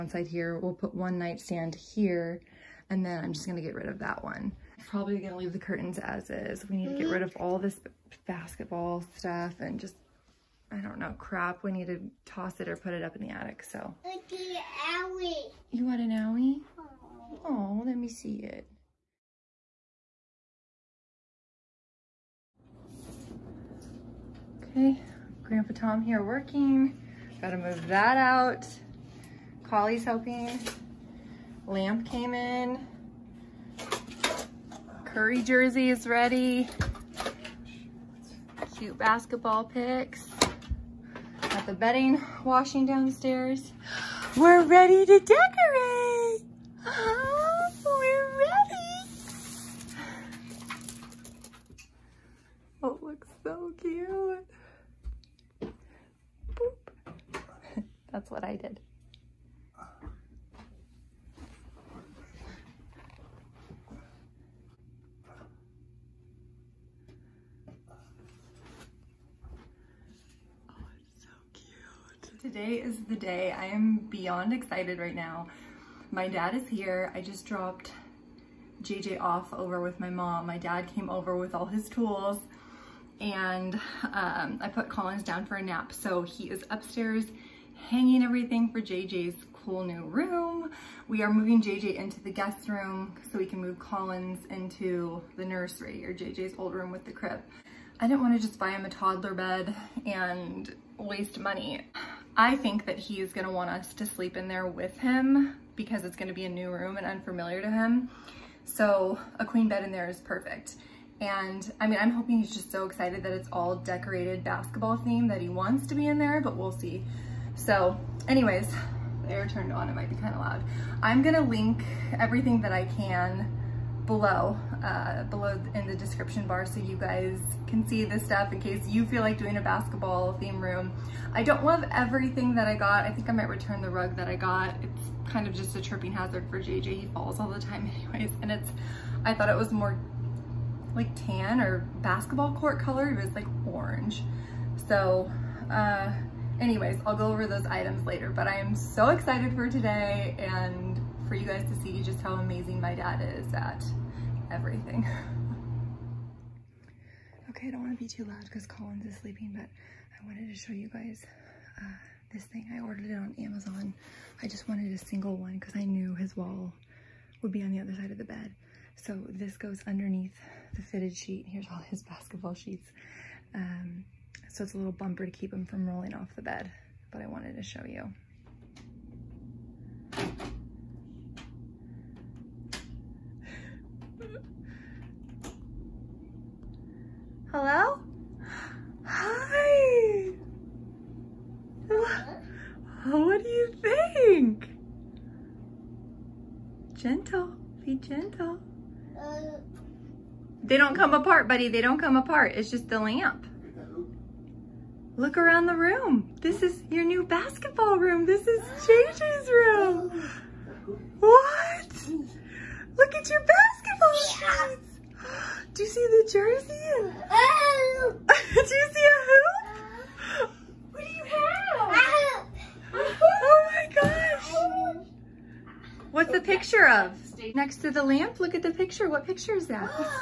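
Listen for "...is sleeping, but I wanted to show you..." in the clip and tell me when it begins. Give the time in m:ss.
2:39.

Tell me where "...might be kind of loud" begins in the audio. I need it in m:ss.
1:59.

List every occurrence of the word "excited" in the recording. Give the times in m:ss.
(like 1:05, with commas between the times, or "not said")
1:14, 1:52, 2:29.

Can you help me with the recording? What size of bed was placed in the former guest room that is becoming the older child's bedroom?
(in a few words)
Queen.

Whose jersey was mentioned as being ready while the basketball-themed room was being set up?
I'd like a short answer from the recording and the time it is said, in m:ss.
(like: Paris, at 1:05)
Curry, at 0:35.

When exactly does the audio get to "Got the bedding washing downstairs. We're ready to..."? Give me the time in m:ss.
0:41.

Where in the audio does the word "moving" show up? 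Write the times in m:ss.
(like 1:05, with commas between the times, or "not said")
1:31.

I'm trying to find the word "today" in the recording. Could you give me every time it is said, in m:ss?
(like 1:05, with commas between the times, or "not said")
1:12, 2:29.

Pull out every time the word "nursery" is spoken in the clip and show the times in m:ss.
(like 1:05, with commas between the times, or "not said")
1:35.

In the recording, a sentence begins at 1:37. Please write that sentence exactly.
I didn't want to just buy him a toddler bed and waste money.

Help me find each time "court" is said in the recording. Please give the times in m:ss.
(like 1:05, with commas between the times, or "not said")
2:22.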